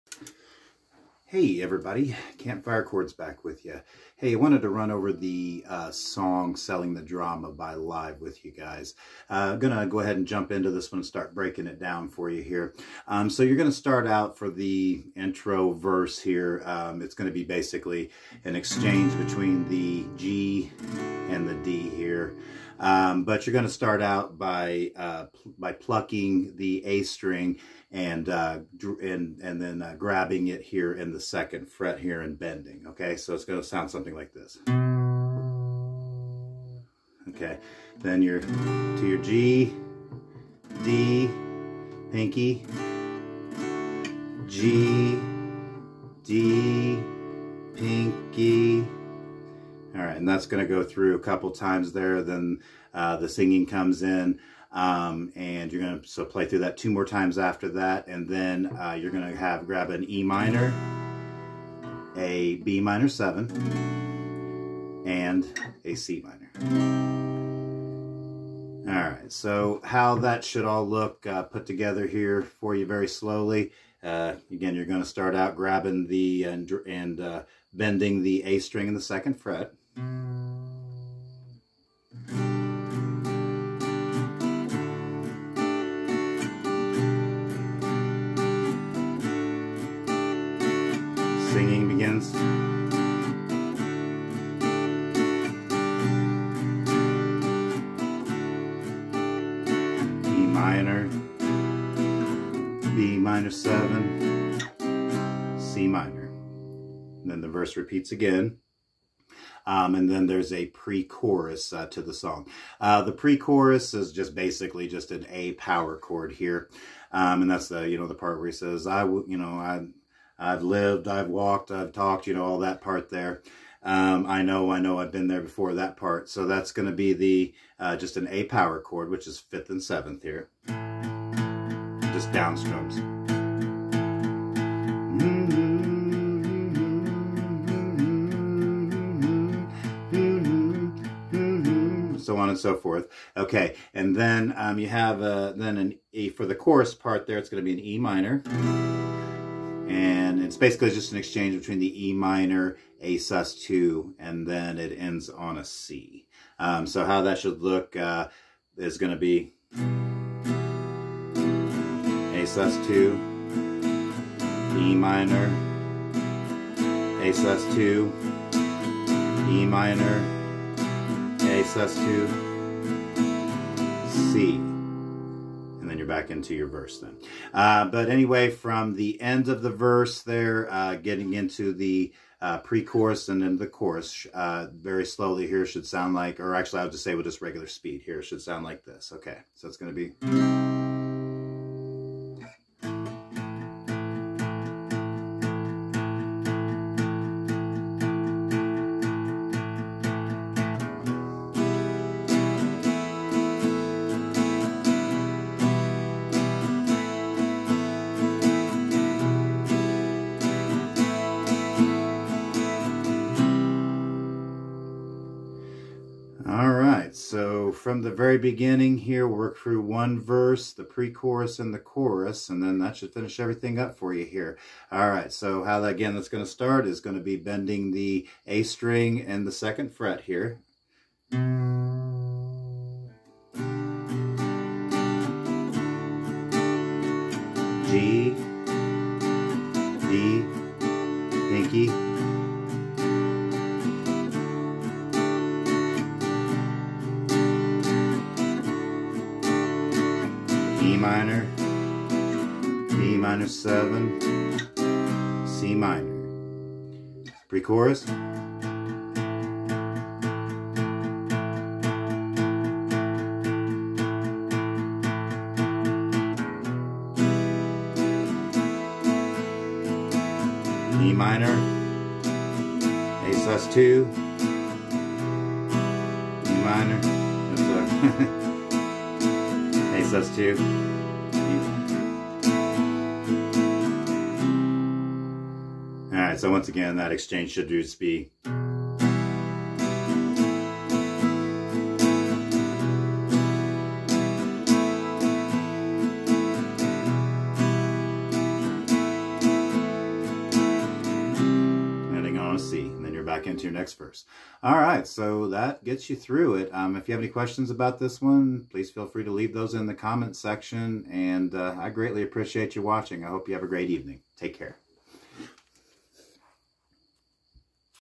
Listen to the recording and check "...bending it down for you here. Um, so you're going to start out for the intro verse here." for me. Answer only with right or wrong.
wrong.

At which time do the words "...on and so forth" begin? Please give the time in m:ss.
2:22.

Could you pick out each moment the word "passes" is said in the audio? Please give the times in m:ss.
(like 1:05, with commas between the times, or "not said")
not said.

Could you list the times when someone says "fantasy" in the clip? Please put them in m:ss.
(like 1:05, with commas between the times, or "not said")
not said.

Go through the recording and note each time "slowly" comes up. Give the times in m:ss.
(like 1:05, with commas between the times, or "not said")
1:13, 3:05.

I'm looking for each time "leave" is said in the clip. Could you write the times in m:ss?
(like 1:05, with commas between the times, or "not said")
5:09.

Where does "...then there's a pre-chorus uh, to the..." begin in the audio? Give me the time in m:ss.
1:50.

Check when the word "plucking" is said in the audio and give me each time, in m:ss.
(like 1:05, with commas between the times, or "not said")
0:25.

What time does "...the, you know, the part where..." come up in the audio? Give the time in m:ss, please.
1:57.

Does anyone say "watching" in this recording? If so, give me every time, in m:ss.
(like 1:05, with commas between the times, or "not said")
5:12.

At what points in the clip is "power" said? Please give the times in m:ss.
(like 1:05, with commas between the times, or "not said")
1:55, 2:08.